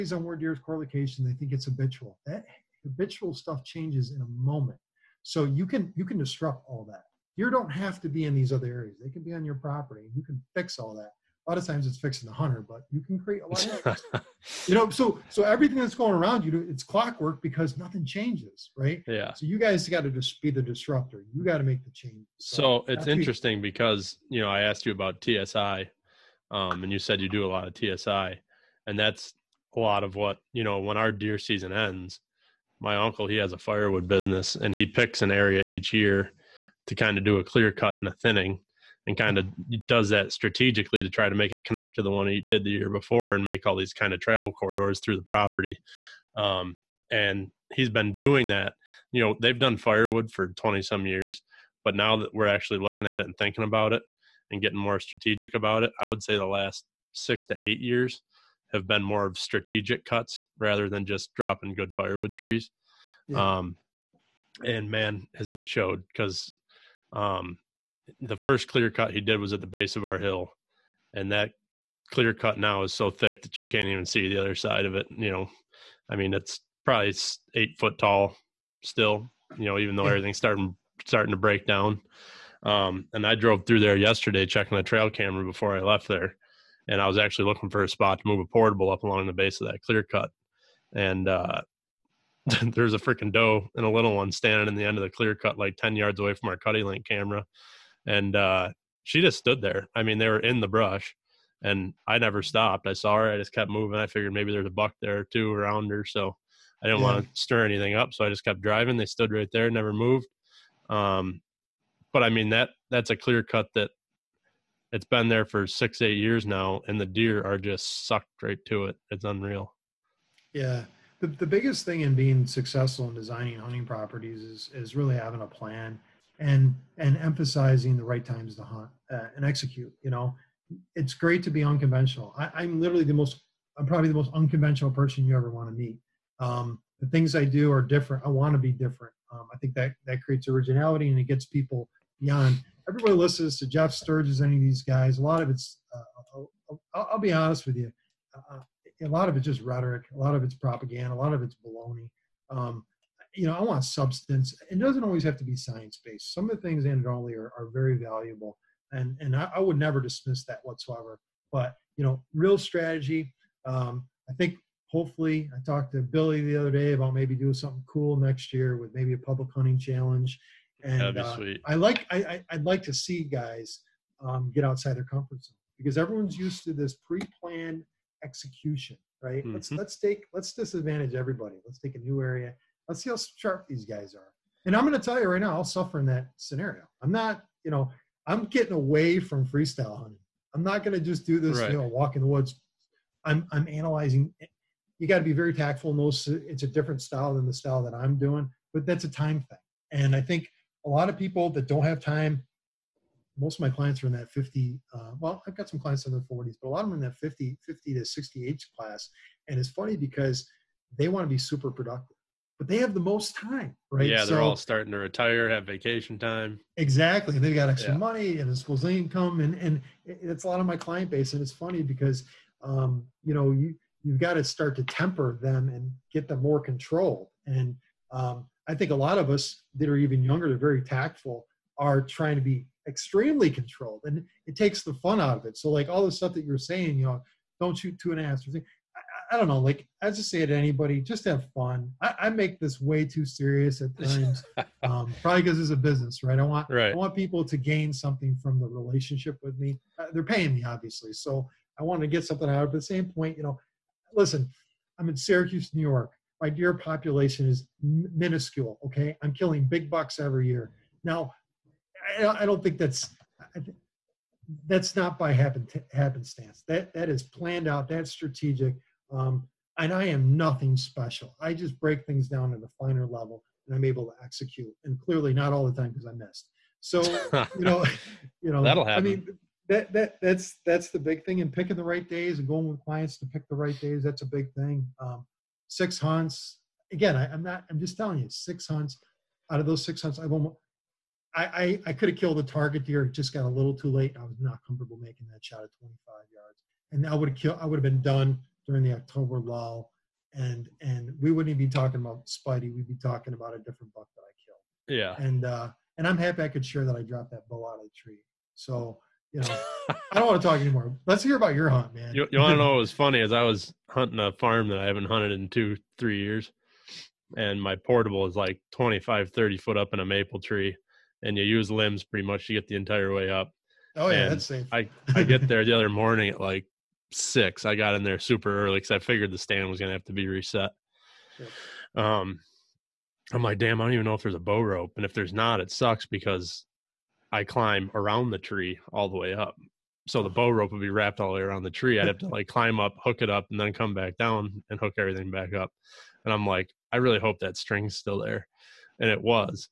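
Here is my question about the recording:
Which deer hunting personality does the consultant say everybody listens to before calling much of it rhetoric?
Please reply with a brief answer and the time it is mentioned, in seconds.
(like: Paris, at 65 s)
Jeff Sturgis, at 143 s.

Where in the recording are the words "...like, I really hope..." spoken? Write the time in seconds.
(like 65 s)
346 s.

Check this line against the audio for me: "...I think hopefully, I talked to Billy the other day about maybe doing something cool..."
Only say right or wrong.
right.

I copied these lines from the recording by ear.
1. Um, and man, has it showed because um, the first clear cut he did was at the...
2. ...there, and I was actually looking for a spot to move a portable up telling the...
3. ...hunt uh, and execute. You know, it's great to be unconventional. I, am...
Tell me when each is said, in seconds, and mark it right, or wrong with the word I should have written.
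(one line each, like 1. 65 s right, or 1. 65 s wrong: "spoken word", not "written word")
1. 63 s right
2. 86 s wrong: "along", not "telling"
3. 128 s right.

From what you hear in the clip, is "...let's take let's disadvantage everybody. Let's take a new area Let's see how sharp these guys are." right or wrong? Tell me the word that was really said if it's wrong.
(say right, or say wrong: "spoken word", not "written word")
right.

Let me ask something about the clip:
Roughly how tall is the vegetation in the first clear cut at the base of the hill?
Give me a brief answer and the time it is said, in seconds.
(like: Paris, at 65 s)
8 feet, at 77 s.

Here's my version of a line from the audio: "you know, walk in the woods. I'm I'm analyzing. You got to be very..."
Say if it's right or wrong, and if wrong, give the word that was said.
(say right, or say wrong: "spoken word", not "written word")
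right.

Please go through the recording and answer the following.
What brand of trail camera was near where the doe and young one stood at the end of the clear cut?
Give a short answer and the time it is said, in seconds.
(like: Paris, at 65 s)
CuddeLink, at 96 s.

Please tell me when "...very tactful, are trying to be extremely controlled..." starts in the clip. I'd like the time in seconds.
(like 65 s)
230 s.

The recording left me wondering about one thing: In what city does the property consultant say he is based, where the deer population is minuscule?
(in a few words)
Syracuse, New York.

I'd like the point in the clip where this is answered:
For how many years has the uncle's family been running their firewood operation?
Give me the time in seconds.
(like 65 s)
50 s.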